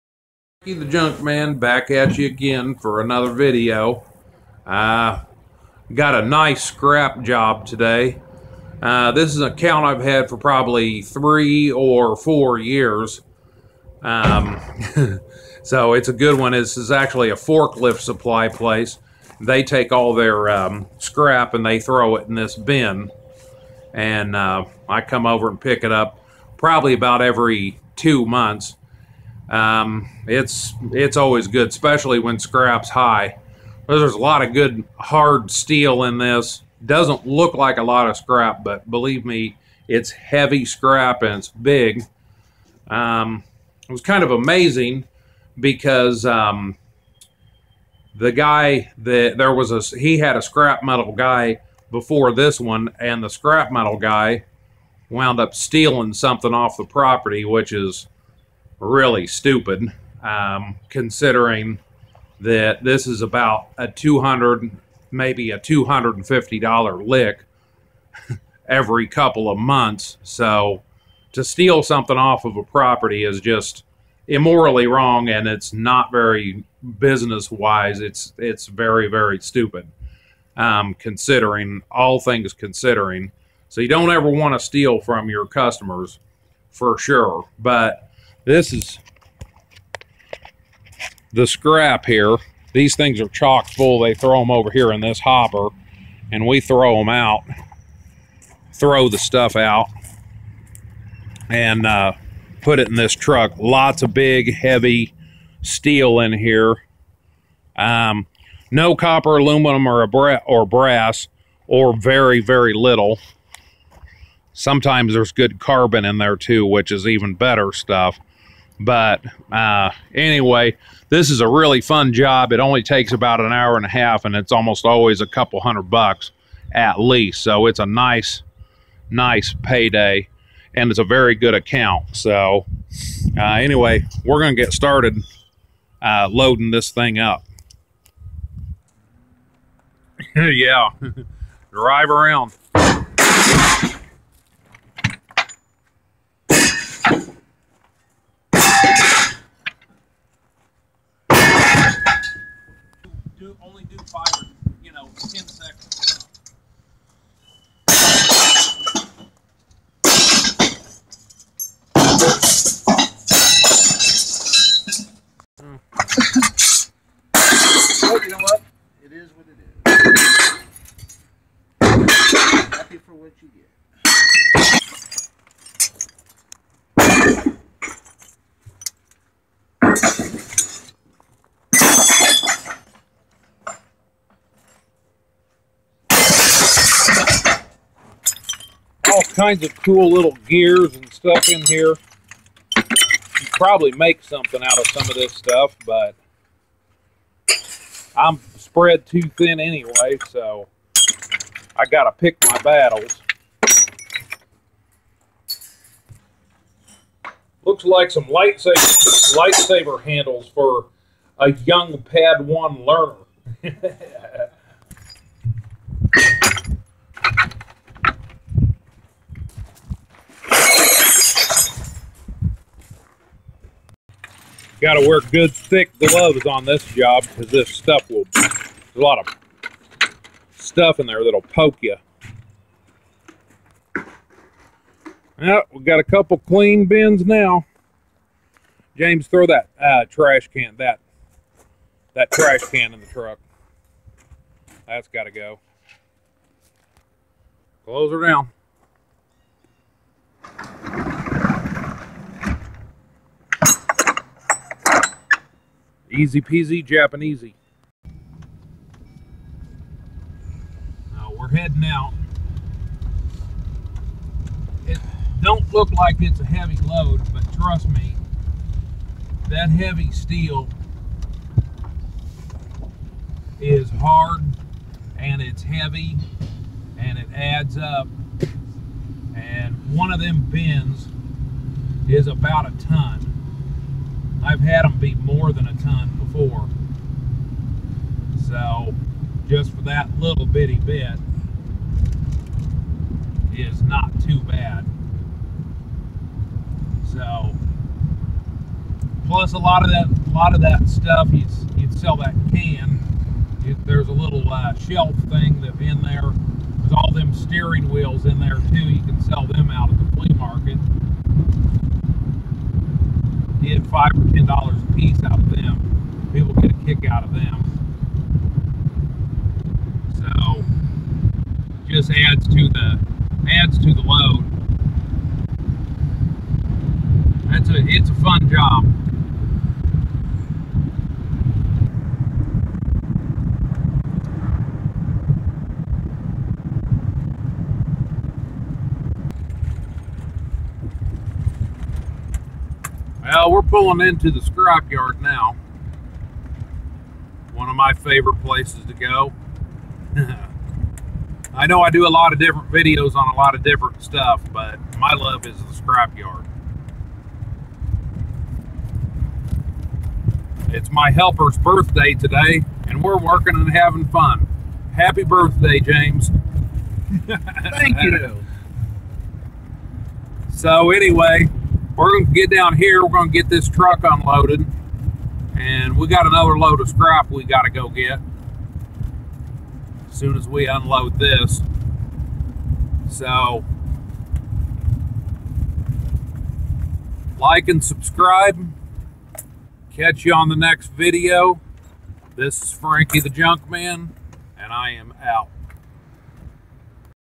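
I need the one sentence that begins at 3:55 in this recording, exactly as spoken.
Now, we've got a couple clean bins now.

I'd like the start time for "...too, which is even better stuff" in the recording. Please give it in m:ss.
1:56.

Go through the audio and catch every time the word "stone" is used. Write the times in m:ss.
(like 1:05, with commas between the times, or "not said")
not said.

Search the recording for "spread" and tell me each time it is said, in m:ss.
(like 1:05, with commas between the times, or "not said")
3:18.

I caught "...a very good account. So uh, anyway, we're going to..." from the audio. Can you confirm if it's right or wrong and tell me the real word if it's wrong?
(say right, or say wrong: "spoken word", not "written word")
right.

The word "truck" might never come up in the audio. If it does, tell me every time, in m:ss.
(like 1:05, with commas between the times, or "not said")
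1:43, 4:03, 6:13.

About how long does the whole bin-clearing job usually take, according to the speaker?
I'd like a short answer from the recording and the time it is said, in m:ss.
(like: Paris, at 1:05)
an hour and a half, at 2:03.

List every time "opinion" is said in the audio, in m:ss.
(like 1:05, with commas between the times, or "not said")
not said.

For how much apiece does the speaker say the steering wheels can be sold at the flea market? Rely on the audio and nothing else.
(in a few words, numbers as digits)
$5 or $10.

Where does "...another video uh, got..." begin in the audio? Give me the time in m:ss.
0:03.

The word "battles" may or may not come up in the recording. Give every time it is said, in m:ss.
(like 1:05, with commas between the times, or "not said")
3:22.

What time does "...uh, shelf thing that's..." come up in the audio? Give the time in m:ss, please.
5:04.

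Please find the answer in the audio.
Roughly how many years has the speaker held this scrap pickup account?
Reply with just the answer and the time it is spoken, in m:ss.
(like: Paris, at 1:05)
3 or 4, at 0:11.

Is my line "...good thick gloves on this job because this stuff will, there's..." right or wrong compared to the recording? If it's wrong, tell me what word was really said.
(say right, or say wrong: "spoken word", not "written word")
right.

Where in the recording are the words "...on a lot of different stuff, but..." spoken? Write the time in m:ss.
5:53.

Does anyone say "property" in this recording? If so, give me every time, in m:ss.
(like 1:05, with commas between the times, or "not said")
0:56, 1:12.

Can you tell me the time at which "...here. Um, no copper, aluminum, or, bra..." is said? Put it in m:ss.
1:46.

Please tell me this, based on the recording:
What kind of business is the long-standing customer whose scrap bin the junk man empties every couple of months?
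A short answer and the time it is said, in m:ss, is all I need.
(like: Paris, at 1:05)
forklift supply place, at 0:17.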